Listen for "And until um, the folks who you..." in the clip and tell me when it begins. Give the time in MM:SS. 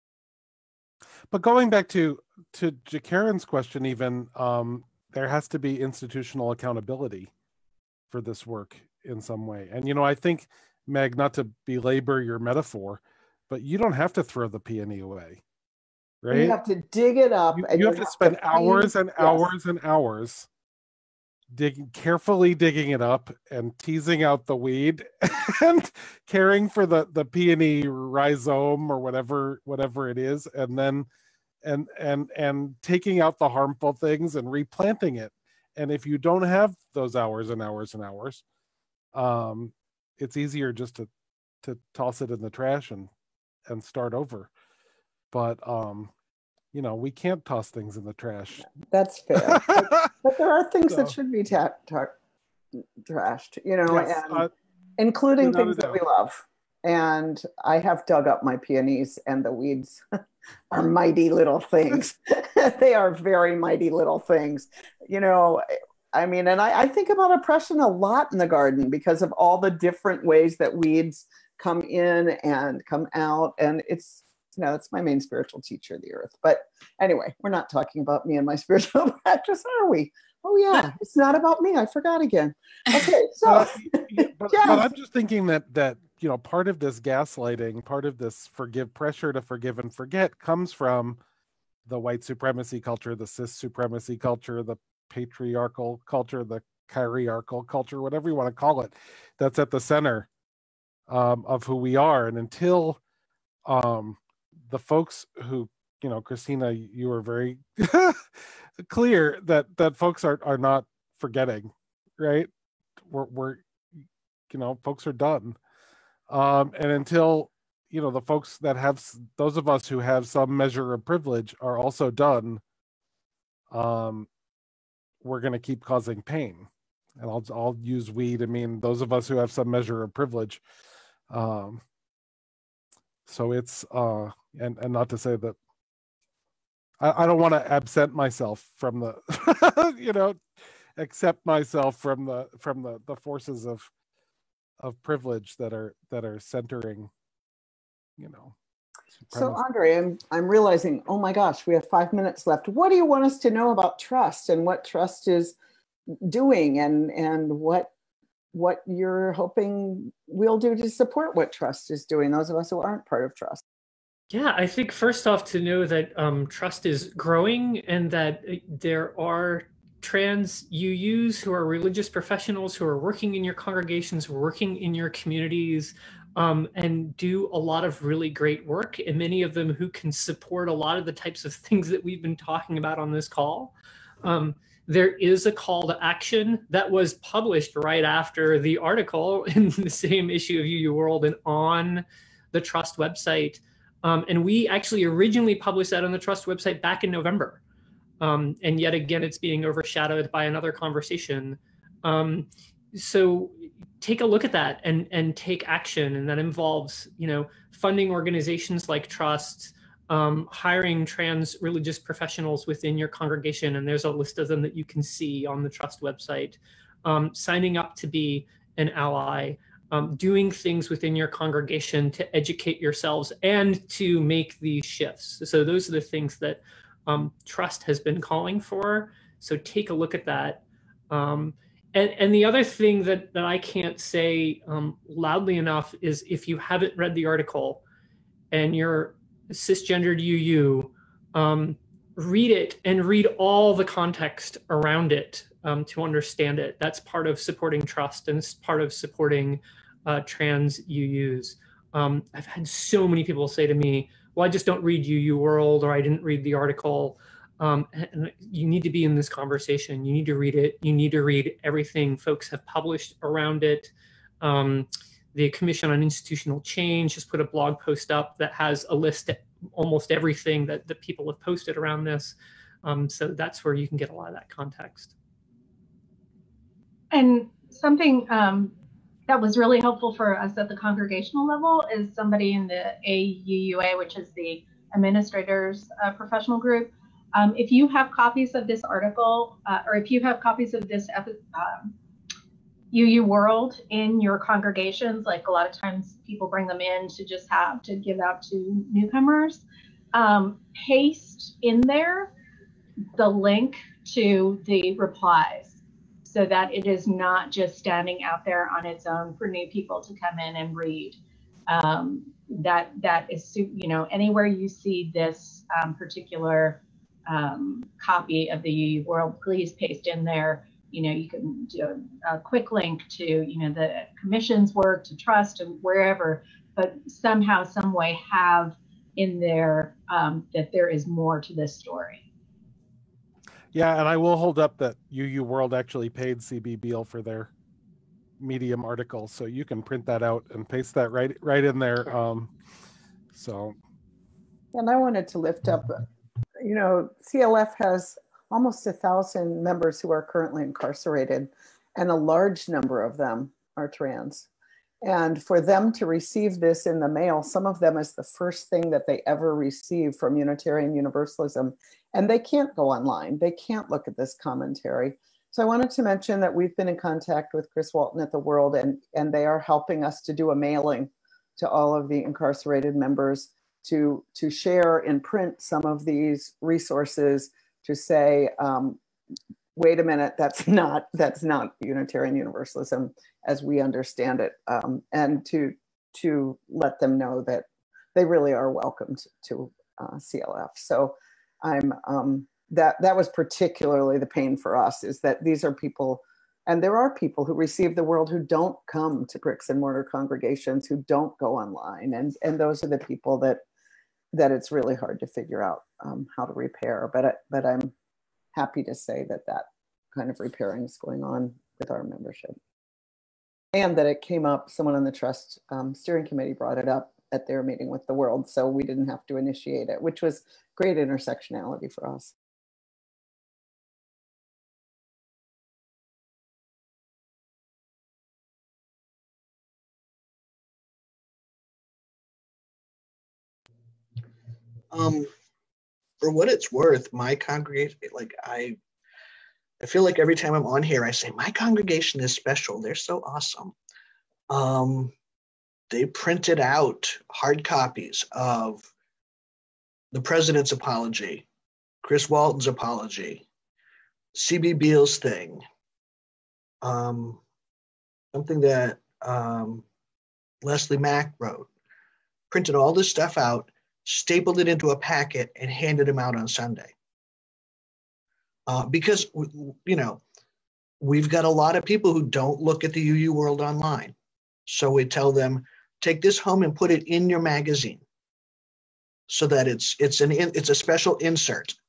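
01:42.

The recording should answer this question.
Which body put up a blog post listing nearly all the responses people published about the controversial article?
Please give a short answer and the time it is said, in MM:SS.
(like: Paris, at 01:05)
Commission on Institutional Change, at 04:25.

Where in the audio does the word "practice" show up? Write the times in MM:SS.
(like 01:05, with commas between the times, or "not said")
01:19.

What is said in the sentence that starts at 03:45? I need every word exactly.
So, those are the things that um, TRUUsT has been calling for.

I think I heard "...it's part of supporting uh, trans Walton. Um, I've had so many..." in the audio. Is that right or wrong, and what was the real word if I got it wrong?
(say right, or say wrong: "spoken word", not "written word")
wrong: "UUs", not "Walton".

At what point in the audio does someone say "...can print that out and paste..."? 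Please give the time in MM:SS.
05:39.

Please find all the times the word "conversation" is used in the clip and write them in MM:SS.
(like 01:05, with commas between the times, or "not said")
03:20, 04:19.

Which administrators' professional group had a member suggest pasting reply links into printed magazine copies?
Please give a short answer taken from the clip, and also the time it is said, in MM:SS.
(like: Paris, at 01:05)
AUUA, at 04:43.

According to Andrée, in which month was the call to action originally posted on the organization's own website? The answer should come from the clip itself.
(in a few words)
November.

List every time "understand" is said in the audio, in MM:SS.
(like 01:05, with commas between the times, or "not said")
04:06, 06:23.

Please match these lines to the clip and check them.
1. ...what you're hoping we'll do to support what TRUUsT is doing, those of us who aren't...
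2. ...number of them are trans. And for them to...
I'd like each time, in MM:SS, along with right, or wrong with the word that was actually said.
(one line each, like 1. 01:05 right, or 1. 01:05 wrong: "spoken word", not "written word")
1. 02:38 right
2. 05:52 right.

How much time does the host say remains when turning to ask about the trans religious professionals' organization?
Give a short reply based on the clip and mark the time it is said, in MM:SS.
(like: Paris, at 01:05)
5 minutes, at 02:31.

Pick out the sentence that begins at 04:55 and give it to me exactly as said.
Like a lot of times people bring them in to just have to give out to newcomers.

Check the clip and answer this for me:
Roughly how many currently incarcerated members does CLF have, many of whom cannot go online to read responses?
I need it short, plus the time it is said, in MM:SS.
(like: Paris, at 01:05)
almost 1000, at 05:48.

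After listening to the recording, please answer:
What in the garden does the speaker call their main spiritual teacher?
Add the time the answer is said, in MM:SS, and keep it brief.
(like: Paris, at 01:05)
the earth, at 01:16.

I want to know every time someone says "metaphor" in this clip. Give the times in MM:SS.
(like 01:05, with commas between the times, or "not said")
00:12.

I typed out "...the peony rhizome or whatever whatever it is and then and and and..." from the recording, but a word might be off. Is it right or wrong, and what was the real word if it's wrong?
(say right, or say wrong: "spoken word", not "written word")
right.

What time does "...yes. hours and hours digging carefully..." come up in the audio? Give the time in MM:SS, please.
00:19.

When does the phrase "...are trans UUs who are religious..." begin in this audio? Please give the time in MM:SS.
02:49.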